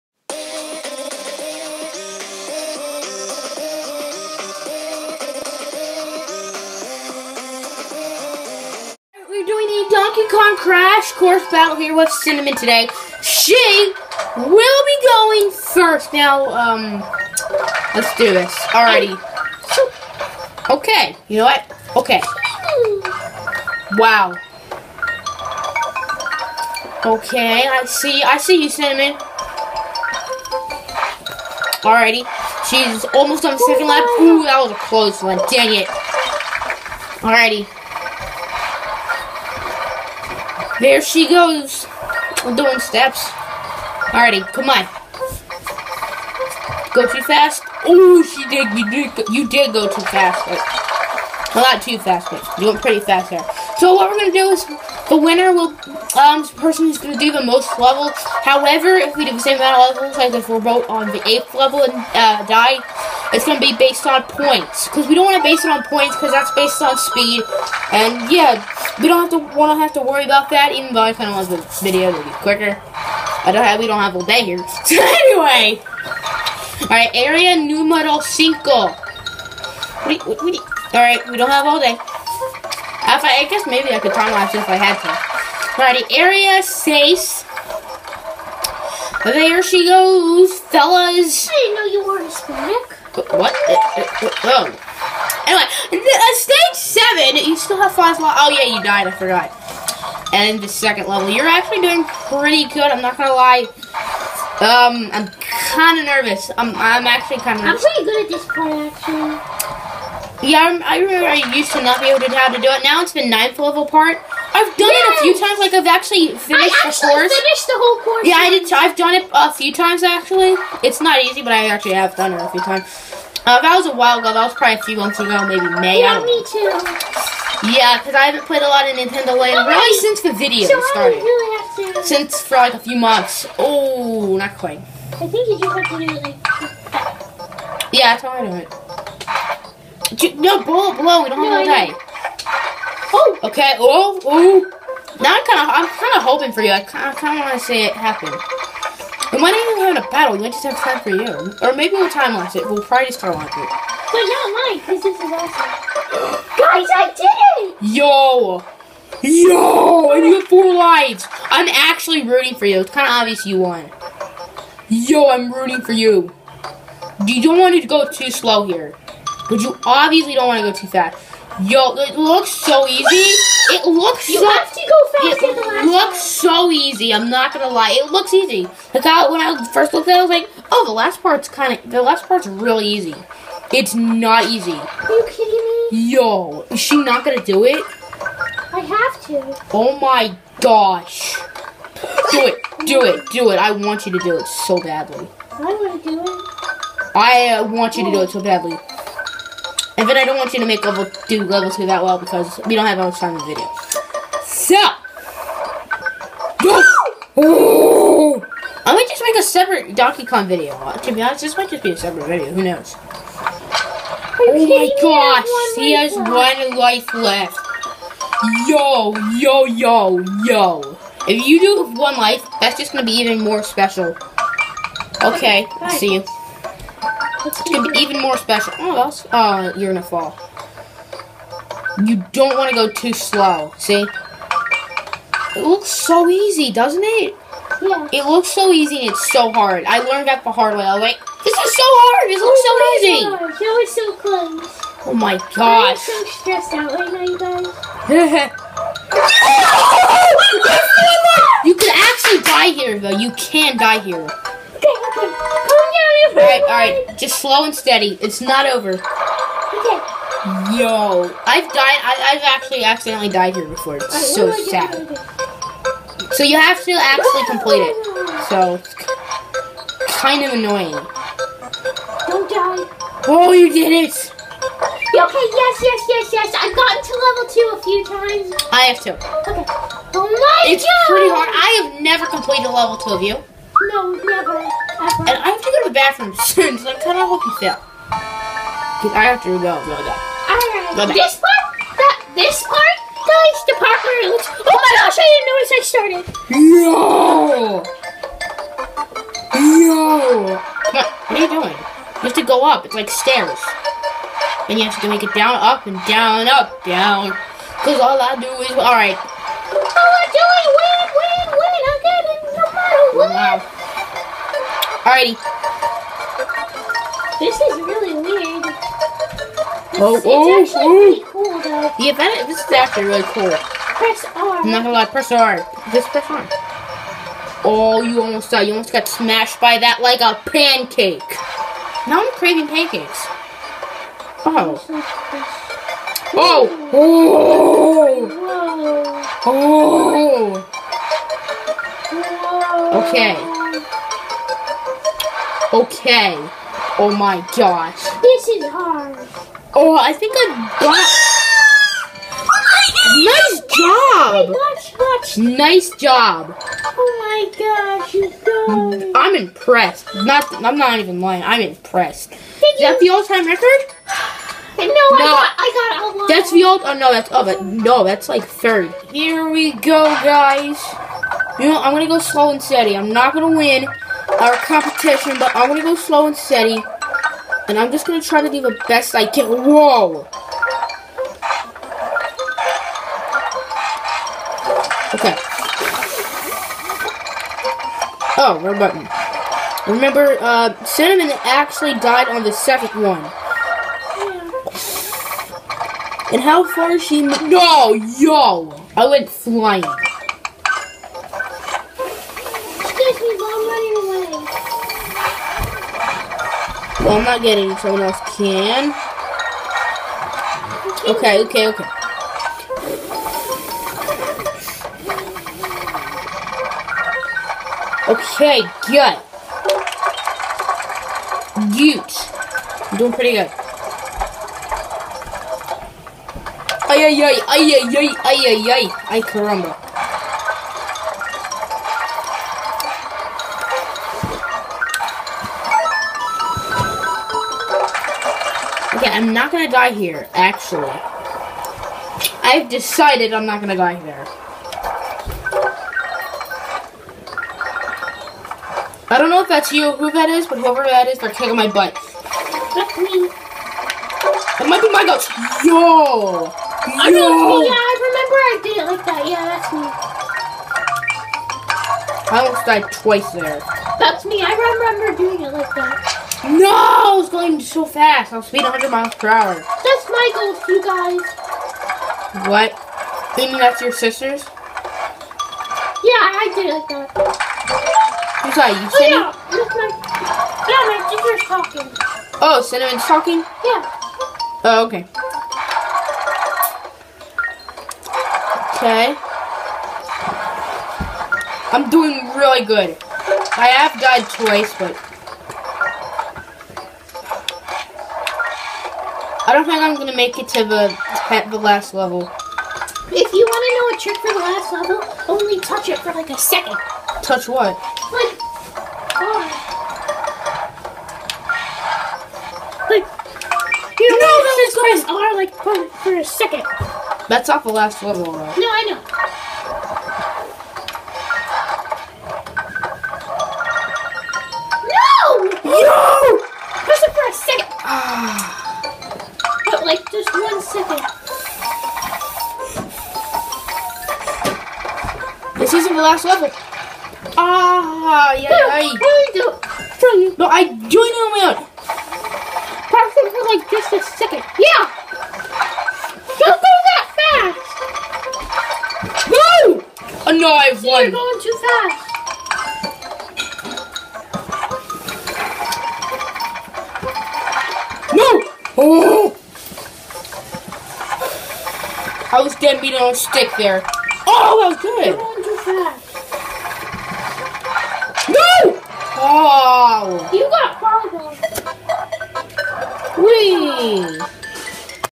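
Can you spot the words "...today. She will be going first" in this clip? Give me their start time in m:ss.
0:12.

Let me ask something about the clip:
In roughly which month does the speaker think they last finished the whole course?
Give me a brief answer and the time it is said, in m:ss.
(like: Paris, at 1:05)
May, at 2:05.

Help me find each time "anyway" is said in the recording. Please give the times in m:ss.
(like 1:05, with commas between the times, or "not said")
1:15, 1:35.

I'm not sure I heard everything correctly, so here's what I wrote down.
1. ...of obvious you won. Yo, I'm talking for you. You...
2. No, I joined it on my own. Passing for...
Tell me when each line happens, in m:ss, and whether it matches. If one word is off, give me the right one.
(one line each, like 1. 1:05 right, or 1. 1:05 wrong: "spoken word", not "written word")
1. 2:43 wrong: "rooting", not "talking"
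2. 9:00 right.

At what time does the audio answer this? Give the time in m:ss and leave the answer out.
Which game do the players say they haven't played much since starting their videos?
2:08.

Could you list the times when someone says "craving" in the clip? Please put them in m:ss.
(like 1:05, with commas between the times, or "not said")
5:32.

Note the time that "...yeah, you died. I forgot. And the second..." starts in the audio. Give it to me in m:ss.
1:38.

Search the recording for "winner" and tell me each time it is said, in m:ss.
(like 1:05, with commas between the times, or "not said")
0:55.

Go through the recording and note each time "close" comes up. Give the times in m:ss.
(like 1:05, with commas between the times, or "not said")
0:34, 4:04.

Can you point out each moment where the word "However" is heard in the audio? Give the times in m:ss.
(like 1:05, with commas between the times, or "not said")
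0:58.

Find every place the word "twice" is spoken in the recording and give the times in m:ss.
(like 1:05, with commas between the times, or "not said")
7:42, 8:14.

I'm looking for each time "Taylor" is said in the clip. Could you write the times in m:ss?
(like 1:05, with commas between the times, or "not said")
not said.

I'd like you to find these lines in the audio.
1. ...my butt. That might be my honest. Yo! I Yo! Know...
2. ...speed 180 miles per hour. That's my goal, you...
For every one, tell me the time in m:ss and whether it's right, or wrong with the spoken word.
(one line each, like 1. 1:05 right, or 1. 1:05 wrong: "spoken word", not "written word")
1. 7:31 wrong: "ghost", not "honest"
2. 7:48 wrong: "100", not "180".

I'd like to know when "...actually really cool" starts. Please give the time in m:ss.
5:22.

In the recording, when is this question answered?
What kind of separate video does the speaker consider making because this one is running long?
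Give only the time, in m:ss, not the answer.
3:29.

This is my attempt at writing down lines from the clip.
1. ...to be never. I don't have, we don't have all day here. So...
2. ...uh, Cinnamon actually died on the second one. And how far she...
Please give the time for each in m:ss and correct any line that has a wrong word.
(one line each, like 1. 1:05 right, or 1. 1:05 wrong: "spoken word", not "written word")
1. 1:12 wrong: "quicker", not "never"
2. 6:30 right.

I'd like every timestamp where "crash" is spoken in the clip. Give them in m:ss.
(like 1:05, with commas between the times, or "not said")
0:10.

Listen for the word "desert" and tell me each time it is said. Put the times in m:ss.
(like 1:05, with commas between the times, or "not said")
not said.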